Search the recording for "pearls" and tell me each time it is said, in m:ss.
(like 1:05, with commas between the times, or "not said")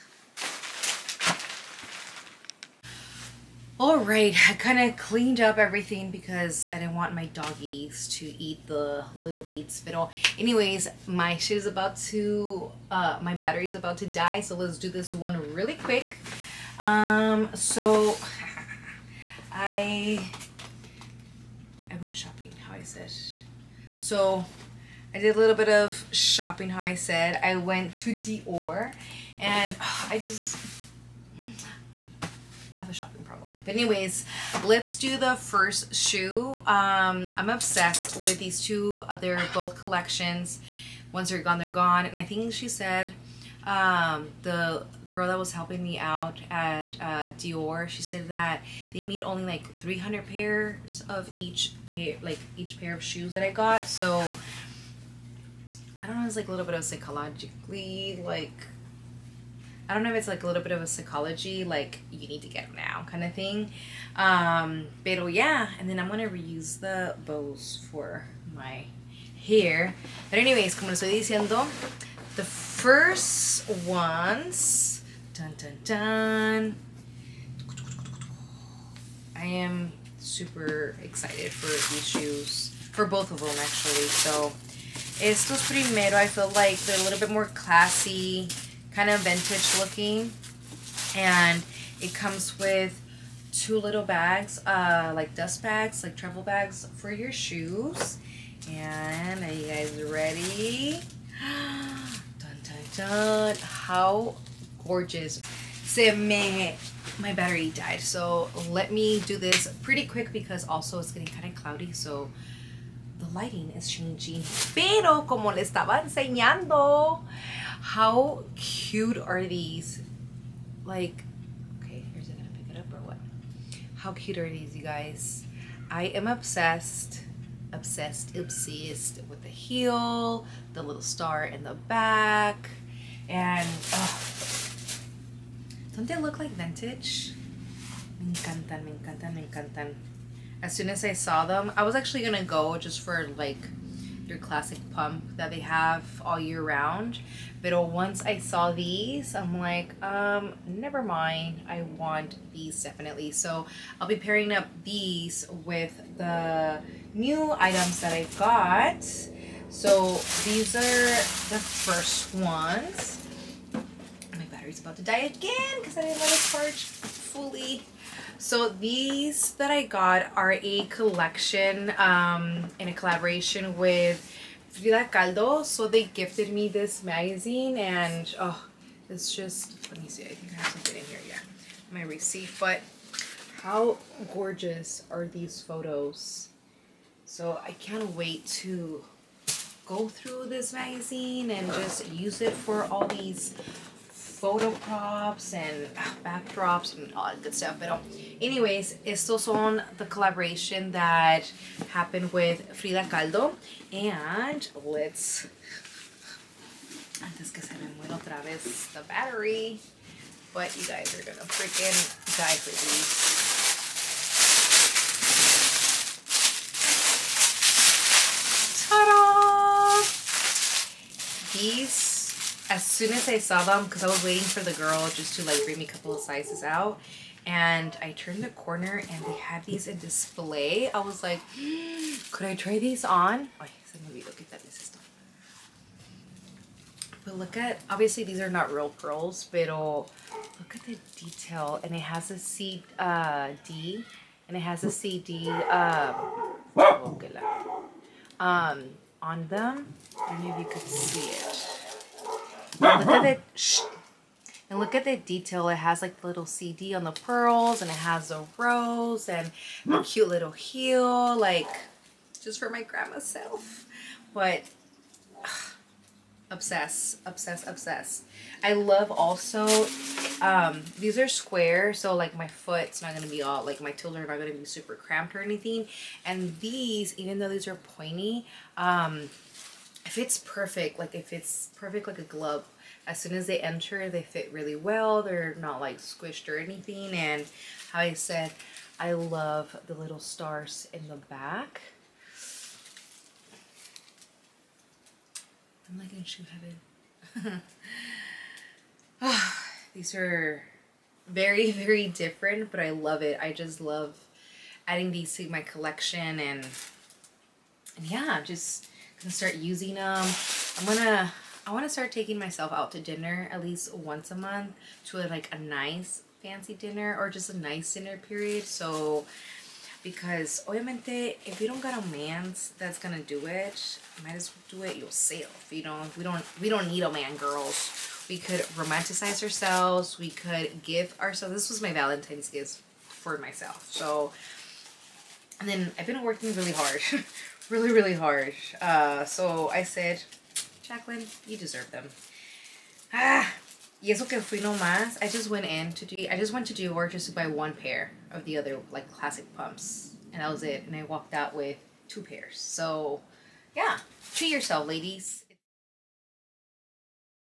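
3:58, 4:17.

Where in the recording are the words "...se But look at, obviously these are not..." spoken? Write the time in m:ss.
3:53.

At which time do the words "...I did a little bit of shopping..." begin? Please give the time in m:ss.
0:25.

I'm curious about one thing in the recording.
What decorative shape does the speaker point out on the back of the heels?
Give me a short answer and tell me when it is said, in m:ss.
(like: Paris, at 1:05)
star, at 2:11.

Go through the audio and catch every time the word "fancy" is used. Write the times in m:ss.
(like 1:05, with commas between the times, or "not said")
5:16.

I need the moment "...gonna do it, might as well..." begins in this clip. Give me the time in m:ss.
5:22.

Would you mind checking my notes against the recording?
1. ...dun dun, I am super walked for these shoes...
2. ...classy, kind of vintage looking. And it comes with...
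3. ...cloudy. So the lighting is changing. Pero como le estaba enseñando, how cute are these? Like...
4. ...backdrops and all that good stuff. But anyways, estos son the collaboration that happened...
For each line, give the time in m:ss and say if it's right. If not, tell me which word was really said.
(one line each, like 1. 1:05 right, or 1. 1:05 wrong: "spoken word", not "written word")
1. 1:15 wrong: "excited", not "walked"
2. 1:27 right
3. 1:51 right
4. 3:16 right.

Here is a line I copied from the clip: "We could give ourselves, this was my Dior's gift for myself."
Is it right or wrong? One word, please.
wrong.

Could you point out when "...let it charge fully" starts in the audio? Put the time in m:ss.
2:46.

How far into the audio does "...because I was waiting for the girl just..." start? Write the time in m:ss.
3:43.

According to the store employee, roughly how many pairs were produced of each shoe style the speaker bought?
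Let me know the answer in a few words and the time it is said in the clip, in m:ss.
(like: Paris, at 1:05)
300, at 0:49.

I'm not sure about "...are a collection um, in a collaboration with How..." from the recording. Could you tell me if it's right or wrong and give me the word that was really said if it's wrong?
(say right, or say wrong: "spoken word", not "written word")
wrong: "Frida", not "How".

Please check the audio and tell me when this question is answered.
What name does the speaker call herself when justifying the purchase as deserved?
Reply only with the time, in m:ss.
5:40.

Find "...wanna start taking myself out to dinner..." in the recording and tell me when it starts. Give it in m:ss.
5:11.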